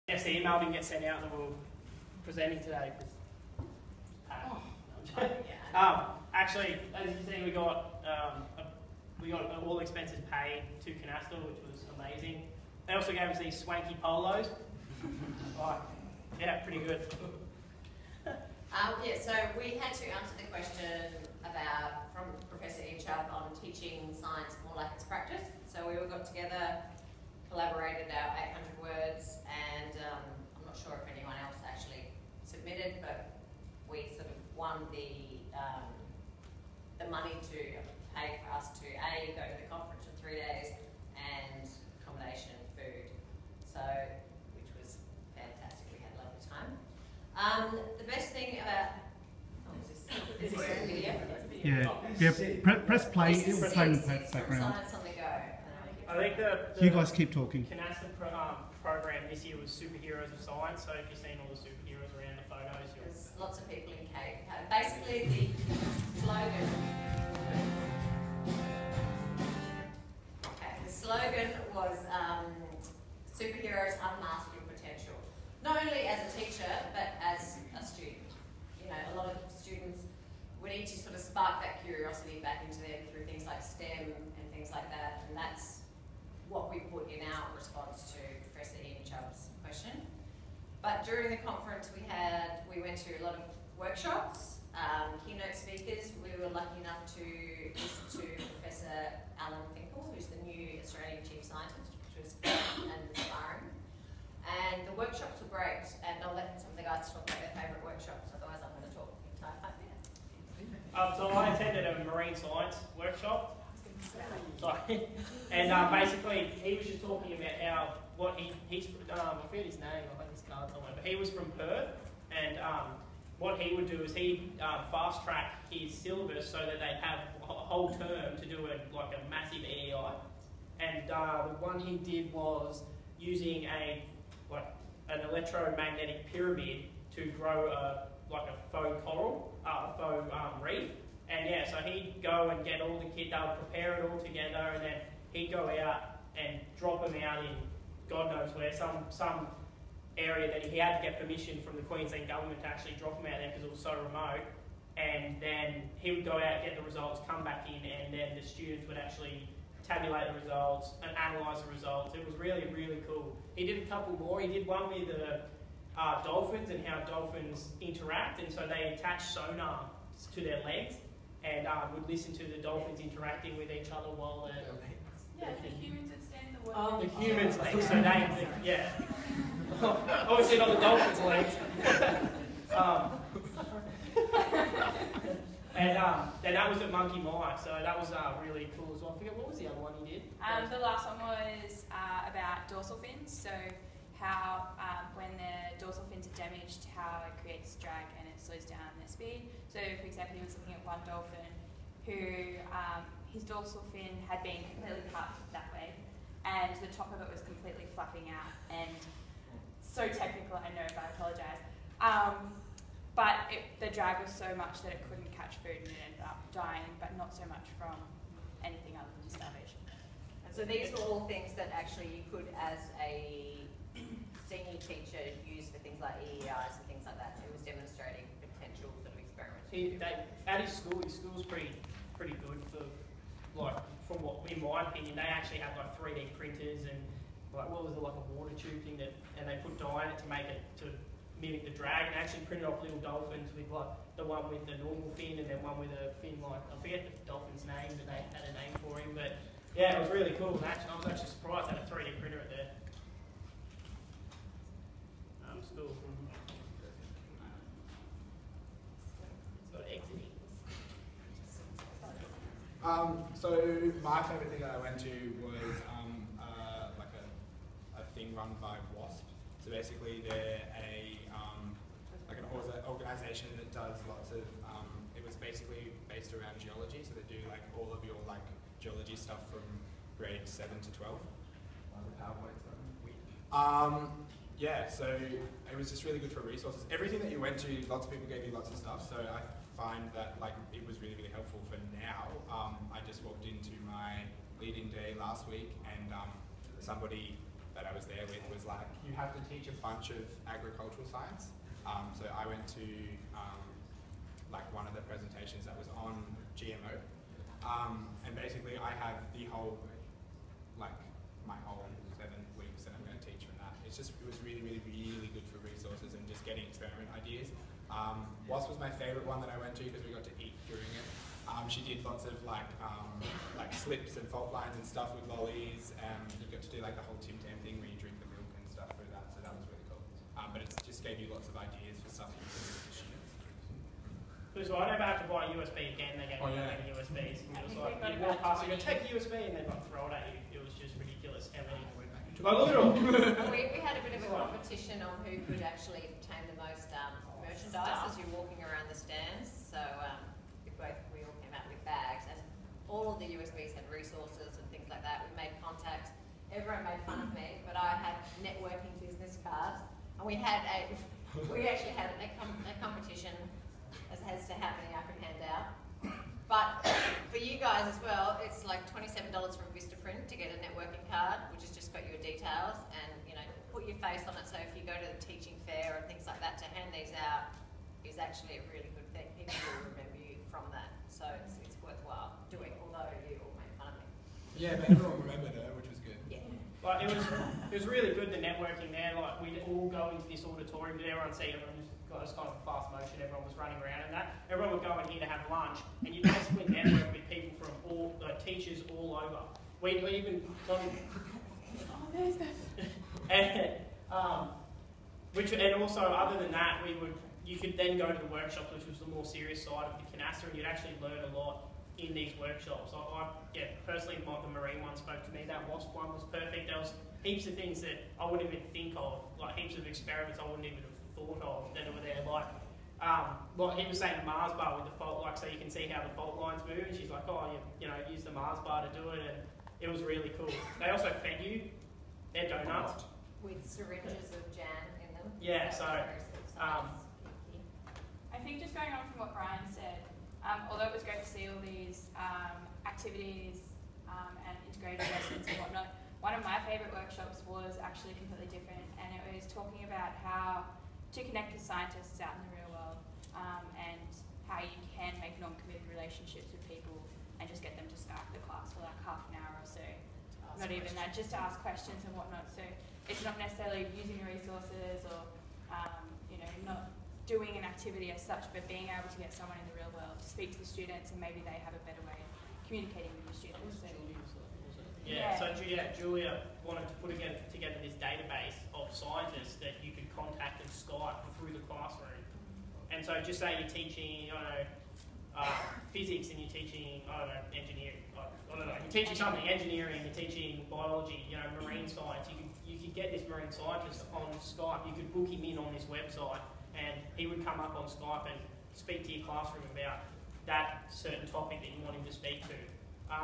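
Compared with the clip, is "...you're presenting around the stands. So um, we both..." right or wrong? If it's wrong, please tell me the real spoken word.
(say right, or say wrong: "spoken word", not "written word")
wrong: "walking", not "presenting".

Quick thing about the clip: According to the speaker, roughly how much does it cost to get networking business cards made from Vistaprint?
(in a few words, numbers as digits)
$27.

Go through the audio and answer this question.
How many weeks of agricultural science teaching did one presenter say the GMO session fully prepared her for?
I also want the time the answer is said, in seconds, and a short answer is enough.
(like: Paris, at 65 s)
7 weeks, at 312 s.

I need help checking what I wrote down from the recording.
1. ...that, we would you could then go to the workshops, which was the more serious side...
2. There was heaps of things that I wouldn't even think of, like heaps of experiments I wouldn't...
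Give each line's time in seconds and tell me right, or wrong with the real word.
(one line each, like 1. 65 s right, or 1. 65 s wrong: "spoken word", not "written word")
1. 406 s right
2. 416 s right.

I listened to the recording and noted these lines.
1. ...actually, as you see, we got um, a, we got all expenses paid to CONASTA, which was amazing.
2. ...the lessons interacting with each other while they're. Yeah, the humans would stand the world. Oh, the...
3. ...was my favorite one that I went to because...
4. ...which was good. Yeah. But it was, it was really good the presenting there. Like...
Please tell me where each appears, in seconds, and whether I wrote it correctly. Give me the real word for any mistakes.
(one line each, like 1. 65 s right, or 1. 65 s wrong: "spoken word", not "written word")
1. 6 s right
2. 172 s wrong: "dolphins", not "lessons"
3. 318 s right
4. 385 s wrong: "networking", not "presenting".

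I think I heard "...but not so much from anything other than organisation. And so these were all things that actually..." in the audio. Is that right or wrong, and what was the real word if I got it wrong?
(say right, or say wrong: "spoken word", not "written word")
wrong: "starvation", not "organisation".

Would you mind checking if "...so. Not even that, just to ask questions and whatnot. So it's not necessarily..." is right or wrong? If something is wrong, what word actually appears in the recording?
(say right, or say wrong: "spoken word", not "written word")
right.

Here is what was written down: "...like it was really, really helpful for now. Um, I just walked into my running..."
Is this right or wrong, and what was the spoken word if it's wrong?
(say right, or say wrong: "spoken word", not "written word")
wrong: "leading", not "running".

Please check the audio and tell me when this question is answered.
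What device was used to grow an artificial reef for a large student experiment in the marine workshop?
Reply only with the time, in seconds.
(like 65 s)
135 s.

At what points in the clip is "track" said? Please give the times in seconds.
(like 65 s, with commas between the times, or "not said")
125 s.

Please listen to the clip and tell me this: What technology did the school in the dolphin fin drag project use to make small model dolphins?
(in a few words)
3D printers.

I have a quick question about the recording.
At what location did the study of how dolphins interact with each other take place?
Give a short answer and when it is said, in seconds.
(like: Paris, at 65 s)
Monkey Mia, at 186 s.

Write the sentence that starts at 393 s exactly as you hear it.
Everyone was running around and that.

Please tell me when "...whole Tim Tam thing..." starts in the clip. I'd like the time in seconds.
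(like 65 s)
327 s.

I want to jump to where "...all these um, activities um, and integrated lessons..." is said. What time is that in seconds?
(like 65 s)
441 s.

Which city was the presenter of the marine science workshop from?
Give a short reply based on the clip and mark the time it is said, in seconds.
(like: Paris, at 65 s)
Perth, at 121 s.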